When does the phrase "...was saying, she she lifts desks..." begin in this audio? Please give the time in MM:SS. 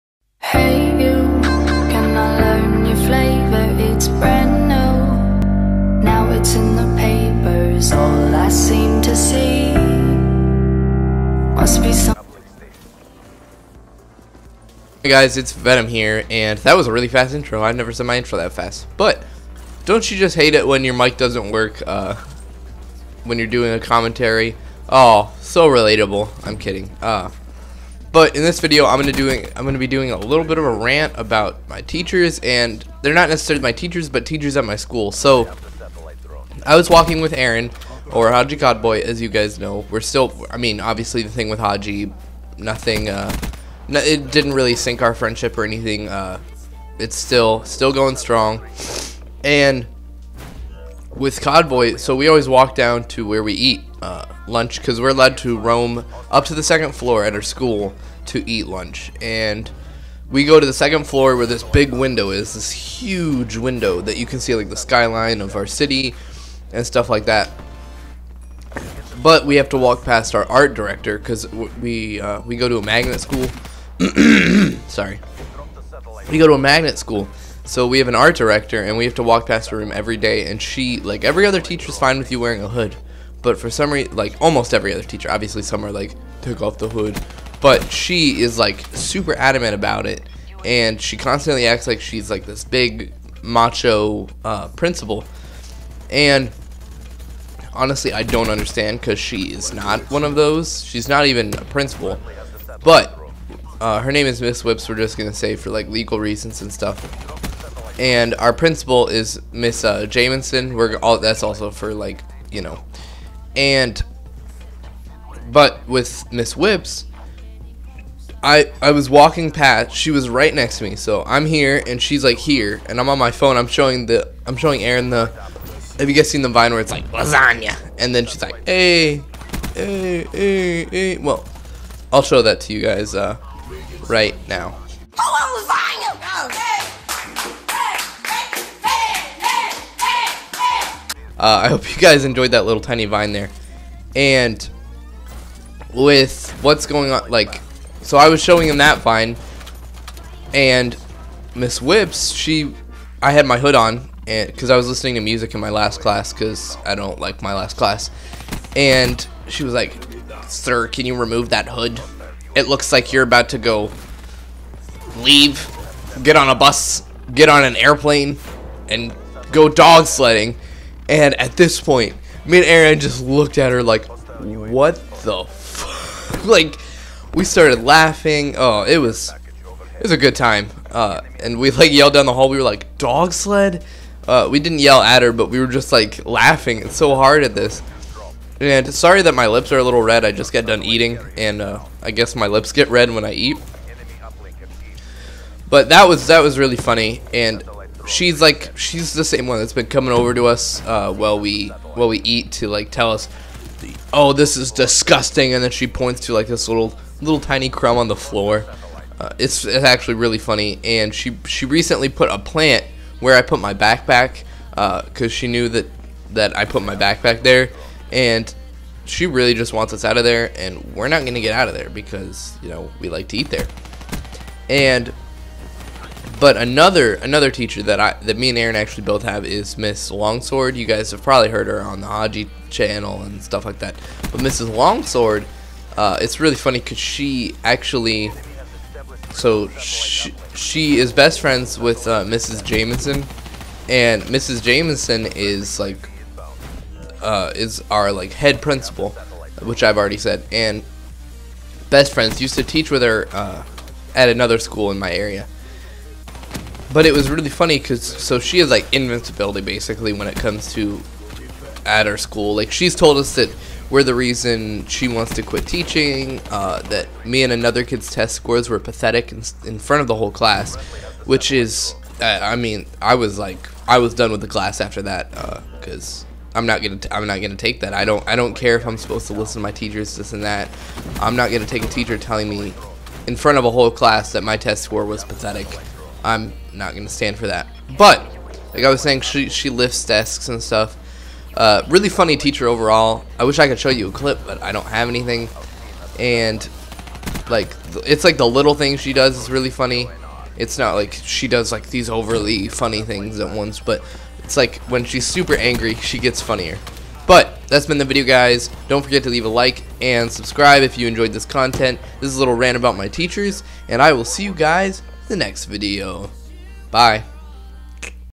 04:48.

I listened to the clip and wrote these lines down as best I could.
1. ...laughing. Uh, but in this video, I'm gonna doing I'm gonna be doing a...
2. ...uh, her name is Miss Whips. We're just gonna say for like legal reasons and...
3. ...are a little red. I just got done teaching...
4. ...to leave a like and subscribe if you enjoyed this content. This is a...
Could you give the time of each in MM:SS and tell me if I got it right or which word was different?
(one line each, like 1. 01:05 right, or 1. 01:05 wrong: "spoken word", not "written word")
1. 00:26 wrong: "kidding", not "laughing"
2. 01:43 right
3. 03:09 wrong: "eating", not "teaching"
4. 05:09 right.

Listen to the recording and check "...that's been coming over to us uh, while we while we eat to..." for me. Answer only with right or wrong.
right.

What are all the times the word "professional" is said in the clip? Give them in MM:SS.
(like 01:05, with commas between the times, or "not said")
not said.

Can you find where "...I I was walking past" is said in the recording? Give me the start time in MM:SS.
01:58.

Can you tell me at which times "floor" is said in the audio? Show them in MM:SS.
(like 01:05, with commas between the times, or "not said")
00:56, 01:01, 03:28.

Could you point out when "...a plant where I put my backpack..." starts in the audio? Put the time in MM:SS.
03:32.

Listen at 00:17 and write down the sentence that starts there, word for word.
I have never said my intro that fast.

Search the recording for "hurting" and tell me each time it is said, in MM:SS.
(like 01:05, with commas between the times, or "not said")
not said.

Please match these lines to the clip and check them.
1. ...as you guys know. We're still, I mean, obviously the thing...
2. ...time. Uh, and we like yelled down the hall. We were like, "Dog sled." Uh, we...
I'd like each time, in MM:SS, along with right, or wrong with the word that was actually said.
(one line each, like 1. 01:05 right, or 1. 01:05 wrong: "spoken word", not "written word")
1. 00:39 right
2. 03:00 right.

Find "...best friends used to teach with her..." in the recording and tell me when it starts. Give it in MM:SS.
04:11.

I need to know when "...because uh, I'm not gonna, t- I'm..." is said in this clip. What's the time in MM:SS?
04:35.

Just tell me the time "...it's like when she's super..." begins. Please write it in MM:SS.
05:04.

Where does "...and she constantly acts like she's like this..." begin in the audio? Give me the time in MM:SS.
01:30.